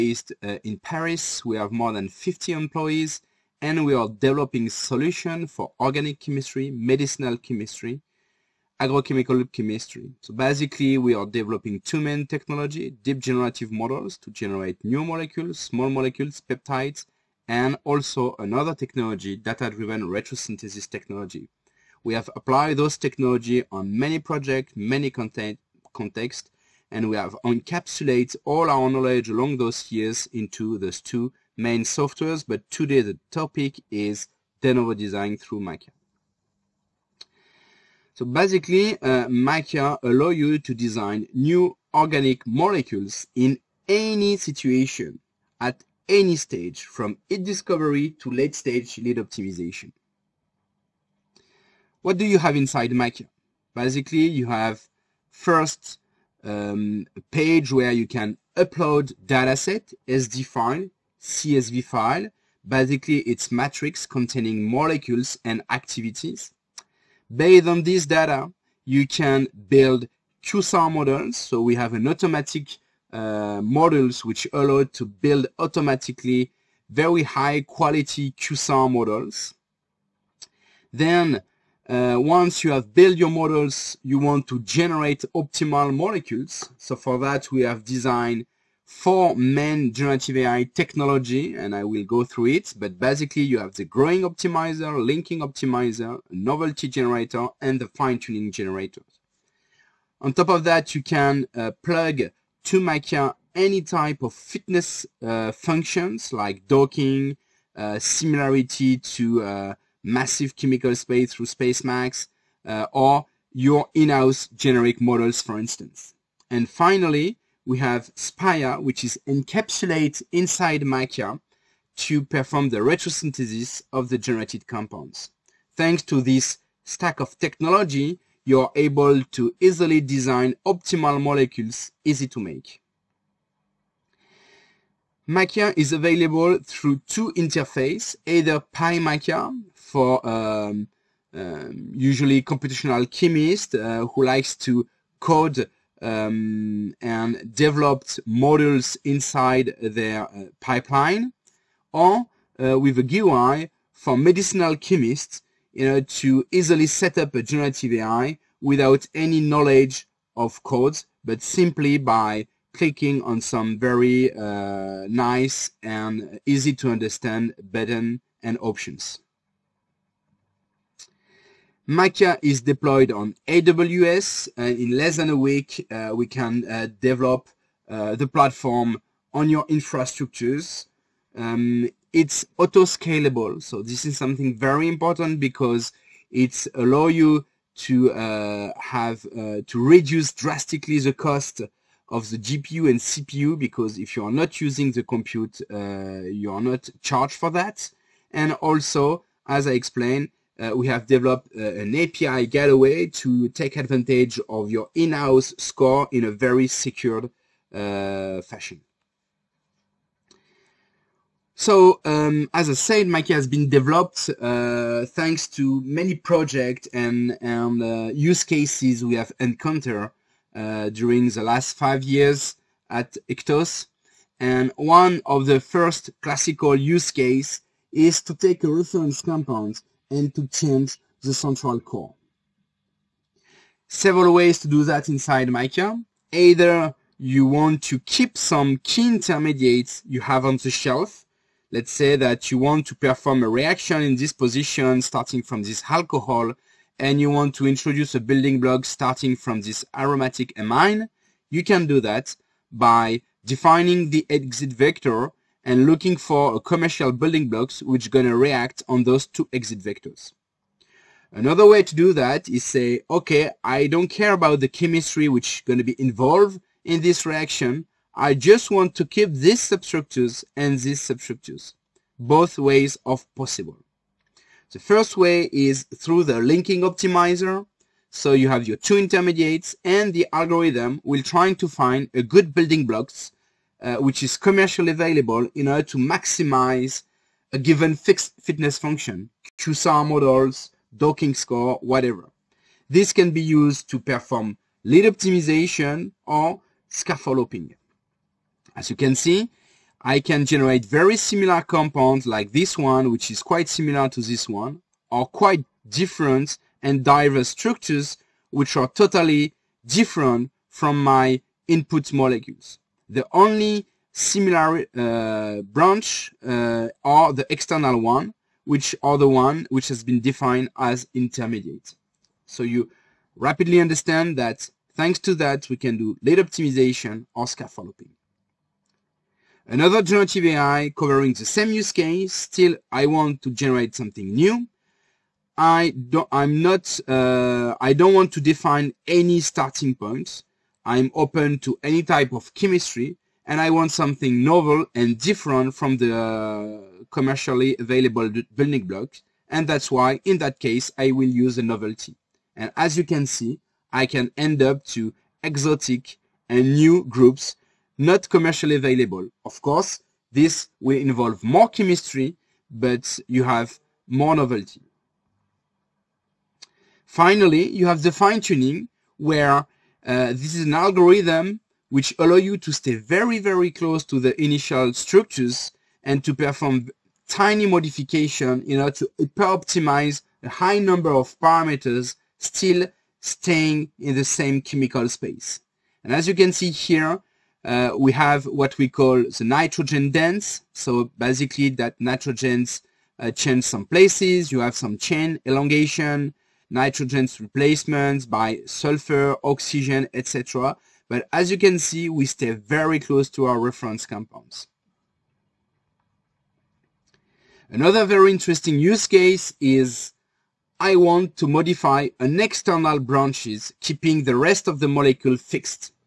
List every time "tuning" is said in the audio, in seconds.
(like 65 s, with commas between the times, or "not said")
97 s, 368 s.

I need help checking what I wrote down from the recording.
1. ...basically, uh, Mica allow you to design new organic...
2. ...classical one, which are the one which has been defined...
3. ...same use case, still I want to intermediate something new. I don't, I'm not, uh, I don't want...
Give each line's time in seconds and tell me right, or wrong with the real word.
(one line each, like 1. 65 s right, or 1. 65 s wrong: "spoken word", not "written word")
1. 38 s right
2. 317 s wrong: "external", not "classical"
3. 331 s wrong: "generate", not "intermediate".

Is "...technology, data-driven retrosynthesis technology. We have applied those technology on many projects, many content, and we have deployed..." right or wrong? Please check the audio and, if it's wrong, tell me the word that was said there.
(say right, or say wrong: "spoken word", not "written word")
wrong: "encapsulated", not "deployed".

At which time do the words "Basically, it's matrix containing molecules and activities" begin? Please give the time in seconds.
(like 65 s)
62 s.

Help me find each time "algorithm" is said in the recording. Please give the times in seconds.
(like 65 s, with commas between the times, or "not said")
280 s, 370 s.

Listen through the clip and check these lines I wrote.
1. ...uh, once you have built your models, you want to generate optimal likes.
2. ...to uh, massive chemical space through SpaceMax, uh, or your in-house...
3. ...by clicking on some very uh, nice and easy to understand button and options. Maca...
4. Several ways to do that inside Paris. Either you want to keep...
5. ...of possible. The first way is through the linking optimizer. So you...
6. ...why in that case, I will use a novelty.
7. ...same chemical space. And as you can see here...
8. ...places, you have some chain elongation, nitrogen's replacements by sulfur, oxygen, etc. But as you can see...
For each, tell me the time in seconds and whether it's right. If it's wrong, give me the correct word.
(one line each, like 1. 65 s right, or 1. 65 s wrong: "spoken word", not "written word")
1. 81 s wrong: "molecules", not "likes"
2. 108 s right
3. 161 s right
4. 233 s wrong: "Mica", not "Paris"
5. 273 s right
6. 349 s right
7. 384 s right
8. 393 s right.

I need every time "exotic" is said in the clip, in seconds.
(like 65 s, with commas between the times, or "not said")
355 s.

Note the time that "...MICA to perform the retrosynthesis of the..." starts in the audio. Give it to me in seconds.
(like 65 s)
120 s.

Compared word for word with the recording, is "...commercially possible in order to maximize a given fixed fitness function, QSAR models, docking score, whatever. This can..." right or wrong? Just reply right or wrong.
wrong.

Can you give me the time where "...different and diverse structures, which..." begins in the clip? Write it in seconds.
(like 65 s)
305 s.